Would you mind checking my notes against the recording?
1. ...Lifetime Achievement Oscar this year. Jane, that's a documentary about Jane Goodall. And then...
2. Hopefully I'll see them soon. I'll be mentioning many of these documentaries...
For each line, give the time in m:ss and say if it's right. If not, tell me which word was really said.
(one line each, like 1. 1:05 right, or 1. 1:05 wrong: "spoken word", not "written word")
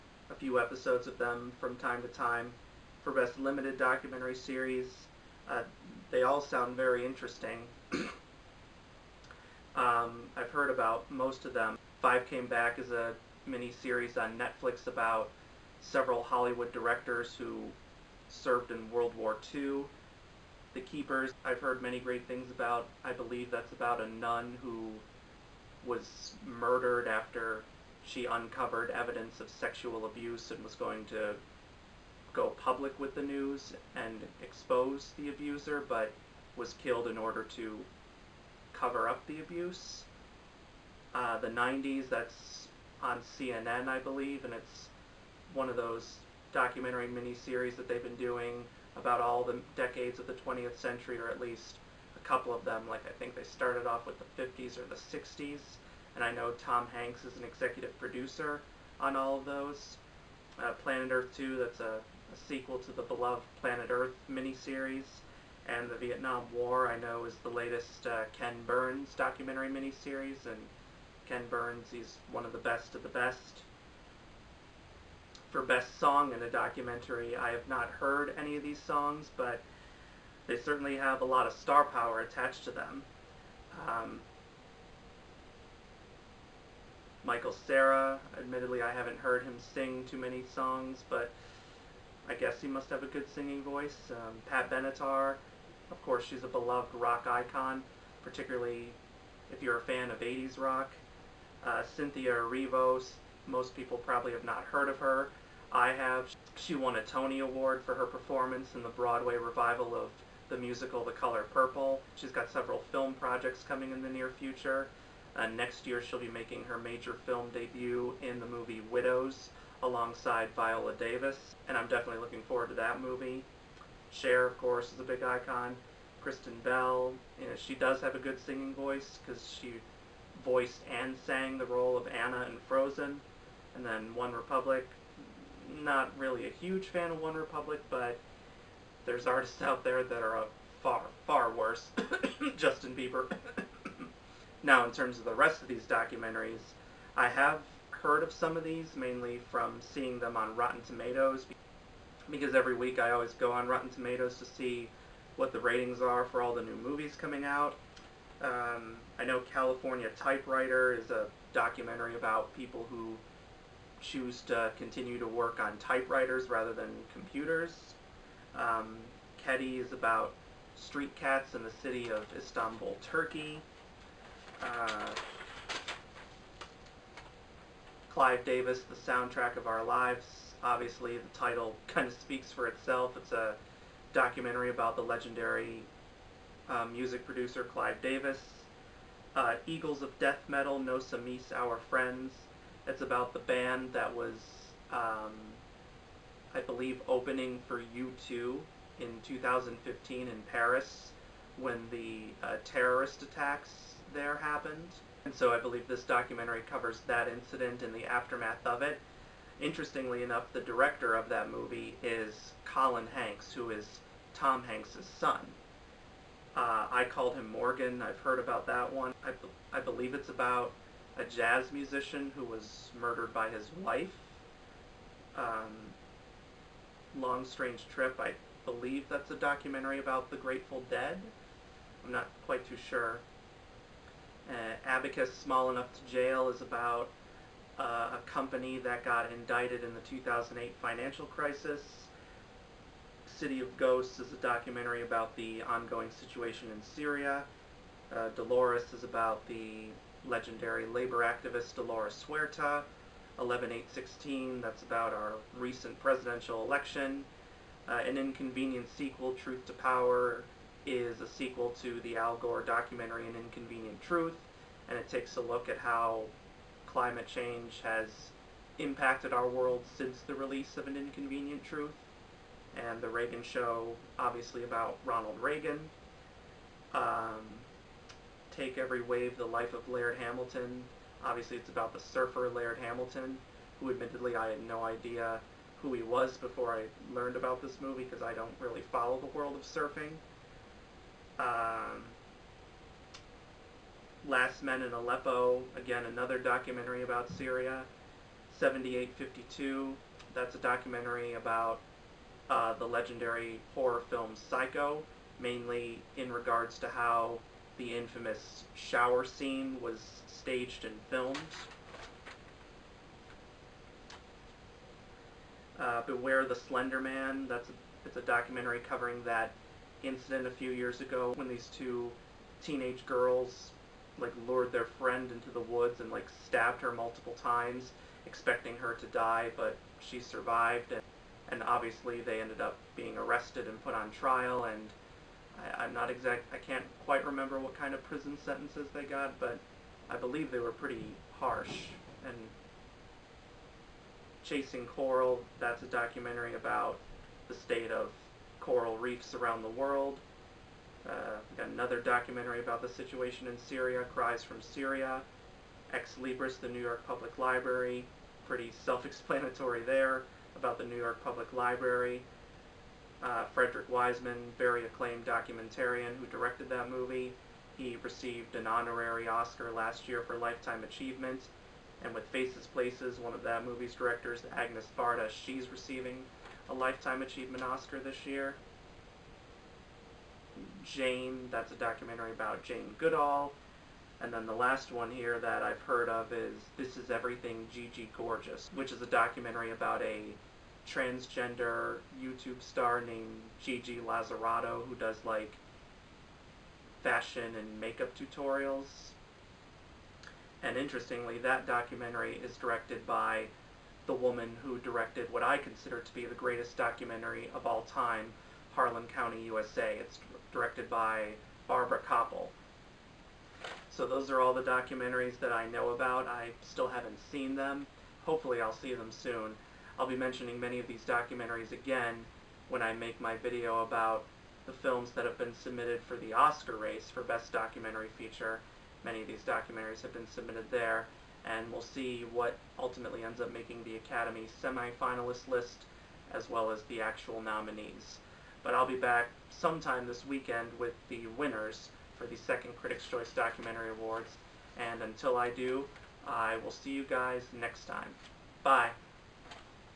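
1. 6:16 right
2. 6:58 right.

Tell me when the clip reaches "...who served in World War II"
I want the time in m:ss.
0:17.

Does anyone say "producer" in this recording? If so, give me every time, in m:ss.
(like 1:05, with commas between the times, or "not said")
0:57, 3:07.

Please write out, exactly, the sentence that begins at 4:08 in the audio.
Uh, Dolores is about the legendary labor activist Dolores Huerta.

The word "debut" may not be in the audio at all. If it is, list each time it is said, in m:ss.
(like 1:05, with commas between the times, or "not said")
1:57.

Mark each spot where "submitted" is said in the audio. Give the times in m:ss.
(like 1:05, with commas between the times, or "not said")
7:05, 7:10.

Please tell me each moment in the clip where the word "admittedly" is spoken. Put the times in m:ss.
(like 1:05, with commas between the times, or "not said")
1:28, 4:43.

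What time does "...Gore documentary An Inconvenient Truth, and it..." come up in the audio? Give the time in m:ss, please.
4:22.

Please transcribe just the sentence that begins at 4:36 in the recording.
Um, Take Every Wave, The Life of Laird Hamilton.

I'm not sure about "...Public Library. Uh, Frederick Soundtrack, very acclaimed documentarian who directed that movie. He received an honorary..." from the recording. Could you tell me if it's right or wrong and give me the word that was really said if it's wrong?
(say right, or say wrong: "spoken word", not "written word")
wrong: "Wiseman", not "Soundtrack".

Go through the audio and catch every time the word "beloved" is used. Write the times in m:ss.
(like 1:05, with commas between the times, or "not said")
1:03, 1:36.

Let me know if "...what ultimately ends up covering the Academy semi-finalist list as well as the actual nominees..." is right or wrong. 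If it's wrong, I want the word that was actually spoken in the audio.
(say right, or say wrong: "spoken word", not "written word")
wrong: "making", not "covering".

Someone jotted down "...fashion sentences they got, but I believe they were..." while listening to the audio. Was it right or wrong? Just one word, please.
wrong.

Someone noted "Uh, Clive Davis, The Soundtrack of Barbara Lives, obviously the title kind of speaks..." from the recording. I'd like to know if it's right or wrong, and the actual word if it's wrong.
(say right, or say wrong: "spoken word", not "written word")
wrong: "Our", not "Barbara".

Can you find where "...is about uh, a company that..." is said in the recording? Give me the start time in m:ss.
3:56.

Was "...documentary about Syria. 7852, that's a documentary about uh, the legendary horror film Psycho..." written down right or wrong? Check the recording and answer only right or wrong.
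right.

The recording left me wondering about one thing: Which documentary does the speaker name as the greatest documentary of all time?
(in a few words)
Harlan County, USA.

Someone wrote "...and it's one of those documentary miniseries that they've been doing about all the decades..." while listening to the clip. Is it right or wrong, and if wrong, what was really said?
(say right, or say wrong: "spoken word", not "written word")
right.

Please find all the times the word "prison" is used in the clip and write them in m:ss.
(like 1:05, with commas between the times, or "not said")
5:38.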